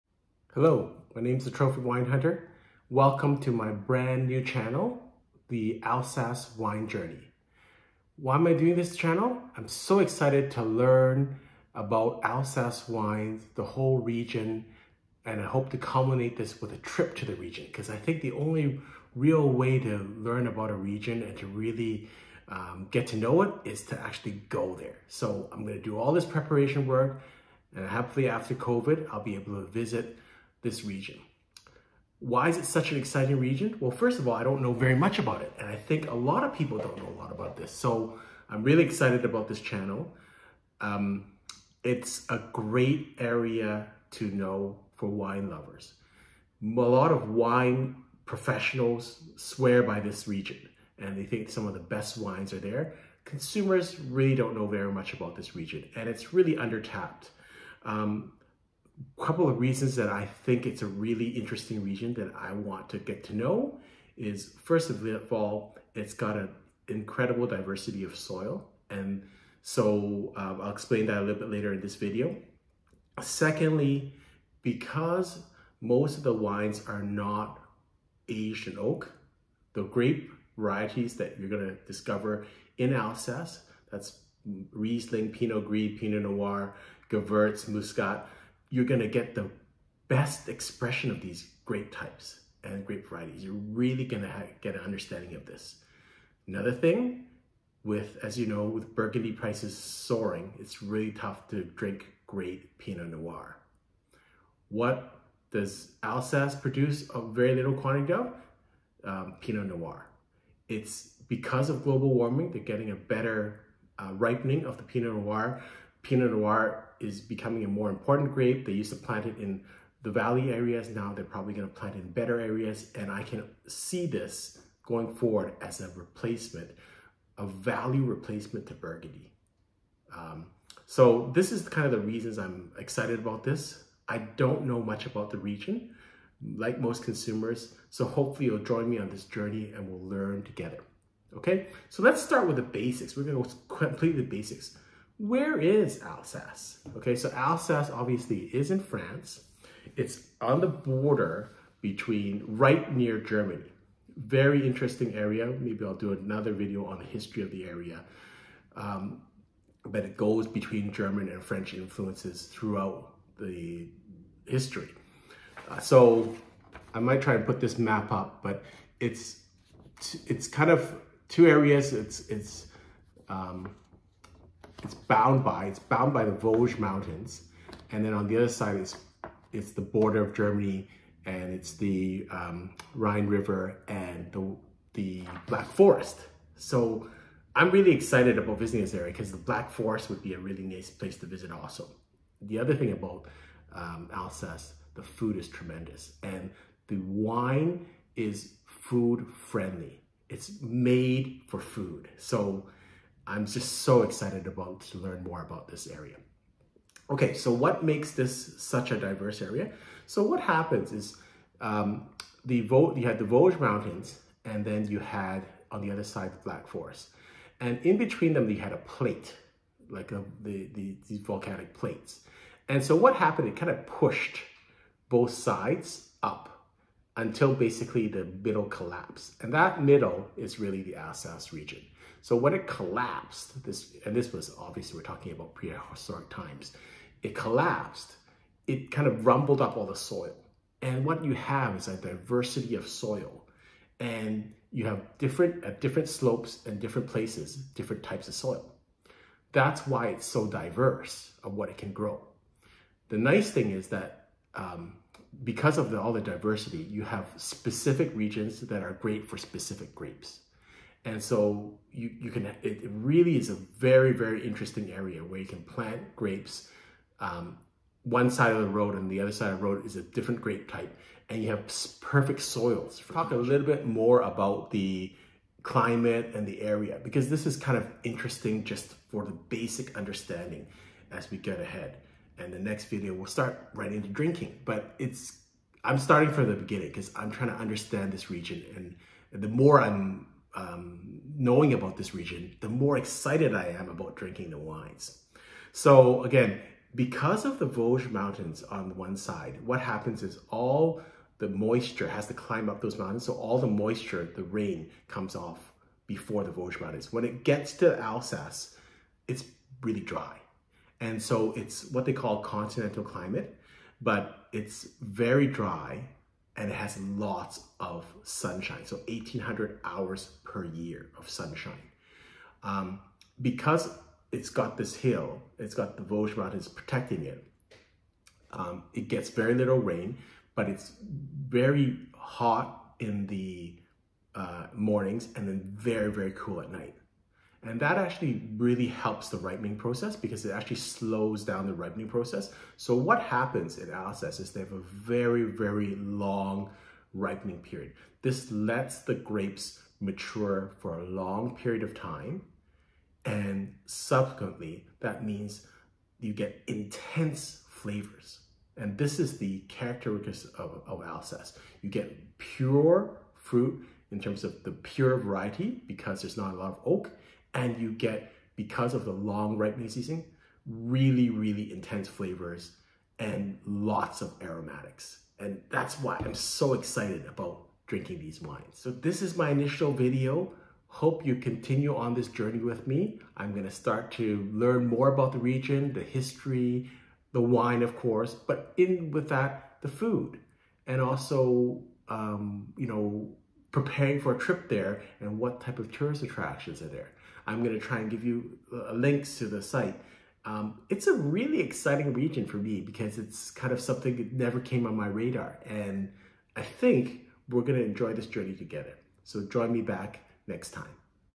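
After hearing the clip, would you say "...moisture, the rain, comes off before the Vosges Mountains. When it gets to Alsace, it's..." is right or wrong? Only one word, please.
right.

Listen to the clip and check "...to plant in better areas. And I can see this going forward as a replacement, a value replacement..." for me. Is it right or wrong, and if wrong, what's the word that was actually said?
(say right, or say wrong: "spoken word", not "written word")
right.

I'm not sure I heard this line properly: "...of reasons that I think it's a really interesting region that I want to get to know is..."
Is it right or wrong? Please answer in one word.
right.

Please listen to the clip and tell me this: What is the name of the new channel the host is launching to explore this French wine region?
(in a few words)
Alsace Wine Journey.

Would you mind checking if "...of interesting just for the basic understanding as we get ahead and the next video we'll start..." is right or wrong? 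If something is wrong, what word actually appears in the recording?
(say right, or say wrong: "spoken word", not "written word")
right.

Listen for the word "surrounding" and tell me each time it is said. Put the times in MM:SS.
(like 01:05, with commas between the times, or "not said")
not said.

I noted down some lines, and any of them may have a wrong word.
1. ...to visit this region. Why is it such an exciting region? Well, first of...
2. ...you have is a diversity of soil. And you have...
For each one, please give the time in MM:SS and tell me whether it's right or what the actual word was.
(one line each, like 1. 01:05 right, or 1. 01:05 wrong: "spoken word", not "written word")
1. 00:29 right
2. 04:01 right.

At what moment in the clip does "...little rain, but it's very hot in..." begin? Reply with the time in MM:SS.
05:29.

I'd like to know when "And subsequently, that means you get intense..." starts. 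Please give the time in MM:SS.
05:53.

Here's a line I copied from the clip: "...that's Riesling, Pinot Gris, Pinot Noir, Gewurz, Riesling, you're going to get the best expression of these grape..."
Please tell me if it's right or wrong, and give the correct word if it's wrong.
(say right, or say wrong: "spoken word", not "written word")
wrong: "Muscat", not "Riesling".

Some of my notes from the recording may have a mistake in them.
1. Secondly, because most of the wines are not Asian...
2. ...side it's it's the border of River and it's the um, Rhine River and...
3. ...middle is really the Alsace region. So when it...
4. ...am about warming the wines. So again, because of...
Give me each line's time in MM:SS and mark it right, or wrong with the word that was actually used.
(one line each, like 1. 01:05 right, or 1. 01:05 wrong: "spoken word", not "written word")
1. 01:13 right
2. 02:58 wrong: "Germany", not "River"
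3. 03:49 right
4. 04:53 wrong: "drinking", not "warming".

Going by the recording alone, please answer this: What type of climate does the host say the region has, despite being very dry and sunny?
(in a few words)
continental climate.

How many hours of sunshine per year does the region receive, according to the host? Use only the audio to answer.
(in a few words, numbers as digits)
1800.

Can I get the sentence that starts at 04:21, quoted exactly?
And so you, you can, it really is a very, very interesting area where you can plant grapes.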